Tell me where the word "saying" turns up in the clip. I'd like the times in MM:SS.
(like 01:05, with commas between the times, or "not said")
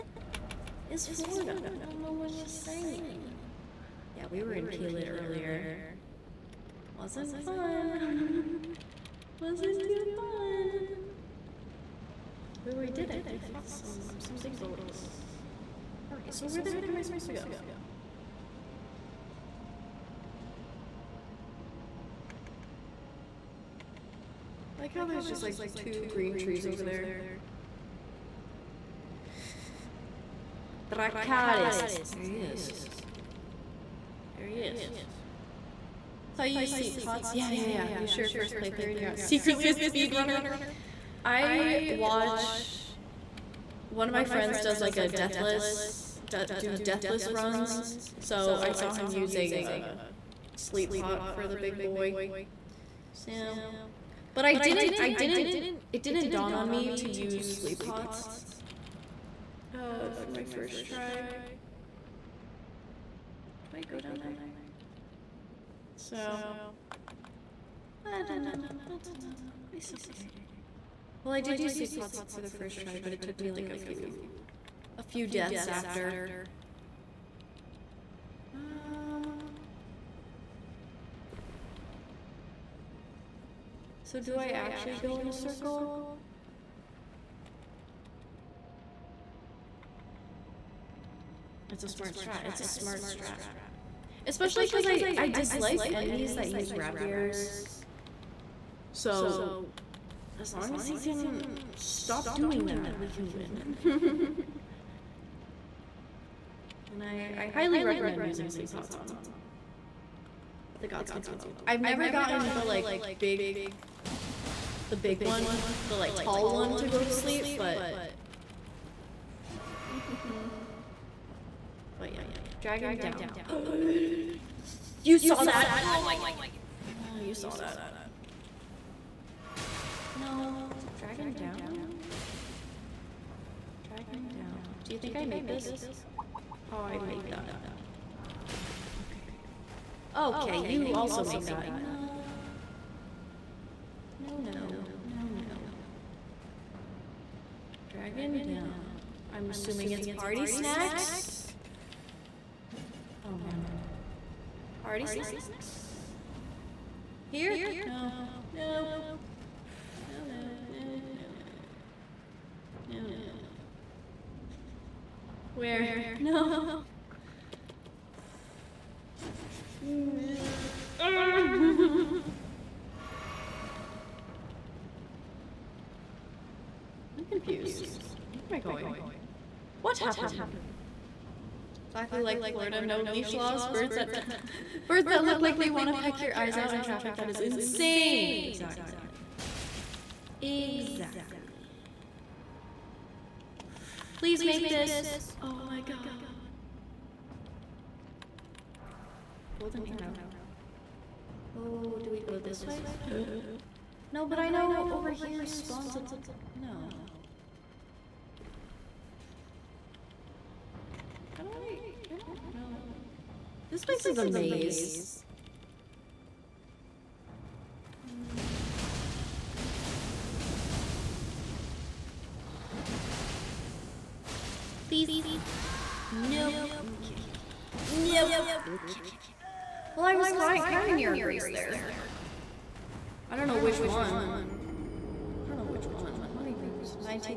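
00:02.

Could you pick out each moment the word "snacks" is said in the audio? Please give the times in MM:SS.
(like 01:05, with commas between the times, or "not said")
02:30, 02:35.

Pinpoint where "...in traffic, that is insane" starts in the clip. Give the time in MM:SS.
03:06.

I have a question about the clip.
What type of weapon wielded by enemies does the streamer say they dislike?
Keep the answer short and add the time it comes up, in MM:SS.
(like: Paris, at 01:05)
rapiers, at 01:36.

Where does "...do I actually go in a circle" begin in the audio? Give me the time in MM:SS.
01:24.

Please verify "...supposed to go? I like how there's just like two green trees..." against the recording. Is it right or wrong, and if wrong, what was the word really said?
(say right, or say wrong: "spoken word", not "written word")
right.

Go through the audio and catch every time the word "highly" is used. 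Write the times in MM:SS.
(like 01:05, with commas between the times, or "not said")
01:47.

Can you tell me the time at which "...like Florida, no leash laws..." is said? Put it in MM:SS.
03:02.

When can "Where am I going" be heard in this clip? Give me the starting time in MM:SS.
02:58.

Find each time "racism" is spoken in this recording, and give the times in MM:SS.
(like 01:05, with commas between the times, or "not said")
not said.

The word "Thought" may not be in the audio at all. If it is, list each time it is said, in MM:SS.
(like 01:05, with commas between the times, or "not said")
00:36.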